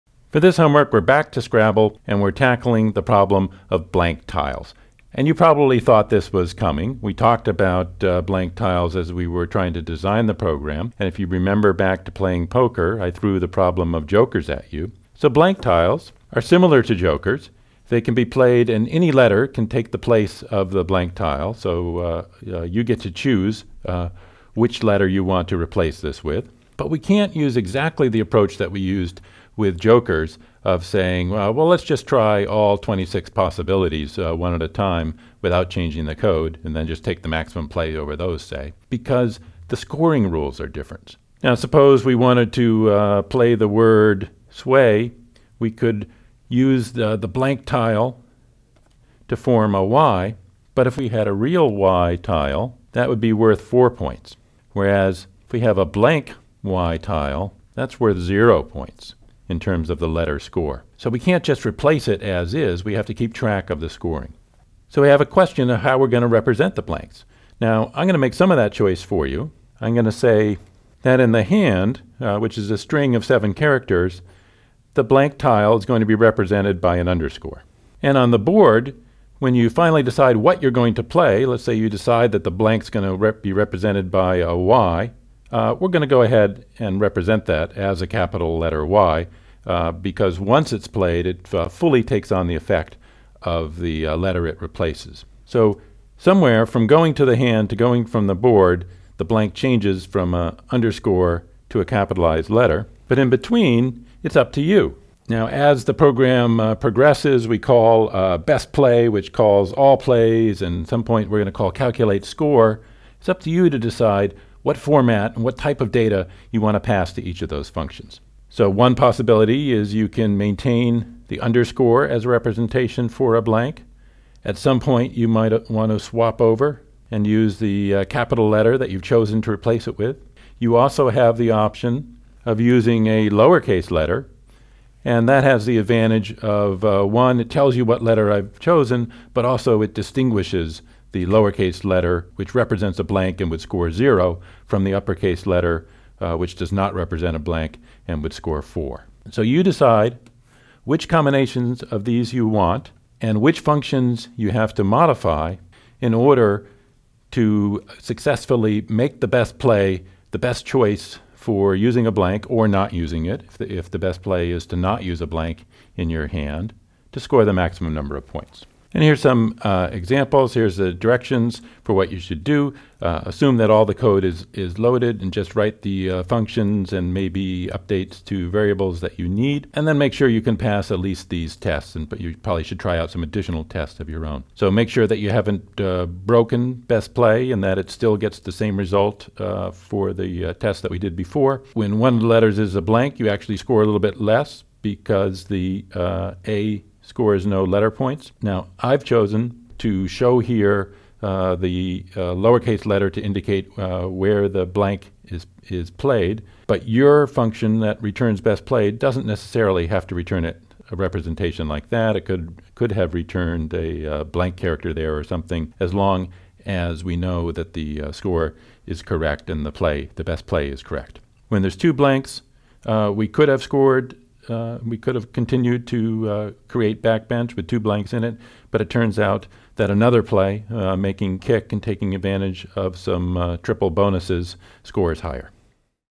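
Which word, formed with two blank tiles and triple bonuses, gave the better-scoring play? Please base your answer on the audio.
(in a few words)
kick.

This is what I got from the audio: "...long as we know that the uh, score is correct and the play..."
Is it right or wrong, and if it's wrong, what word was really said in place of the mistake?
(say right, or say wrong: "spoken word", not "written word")
right.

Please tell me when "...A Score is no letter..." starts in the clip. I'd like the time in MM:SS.
03:16.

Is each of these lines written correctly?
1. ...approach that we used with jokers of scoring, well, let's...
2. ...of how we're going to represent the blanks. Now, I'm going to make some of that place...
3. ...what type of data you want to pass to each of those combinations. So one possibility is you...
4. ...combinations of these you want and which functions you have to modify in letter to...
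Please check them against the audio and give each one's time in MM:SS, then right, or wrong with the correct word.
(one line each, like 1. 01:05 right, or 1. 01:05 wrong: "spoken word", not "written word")
1. 00:28 wrong: "saying", not "scoring"
2. 01:05 wrong: "choice", not "place"
3. 01:55 wrong: "functions", not "combinations"
4. 02:31 wrong: "order", not "letter".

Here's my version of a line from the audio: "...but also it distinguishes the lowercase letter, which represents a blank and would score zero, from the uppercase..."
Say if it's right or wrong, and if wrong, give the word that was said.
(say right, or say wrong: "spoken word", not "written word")
right.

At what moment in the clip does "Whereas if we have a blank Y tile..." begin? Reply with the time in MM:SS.
00:54.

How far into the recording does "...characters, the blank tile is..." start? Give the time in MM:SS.
01:13.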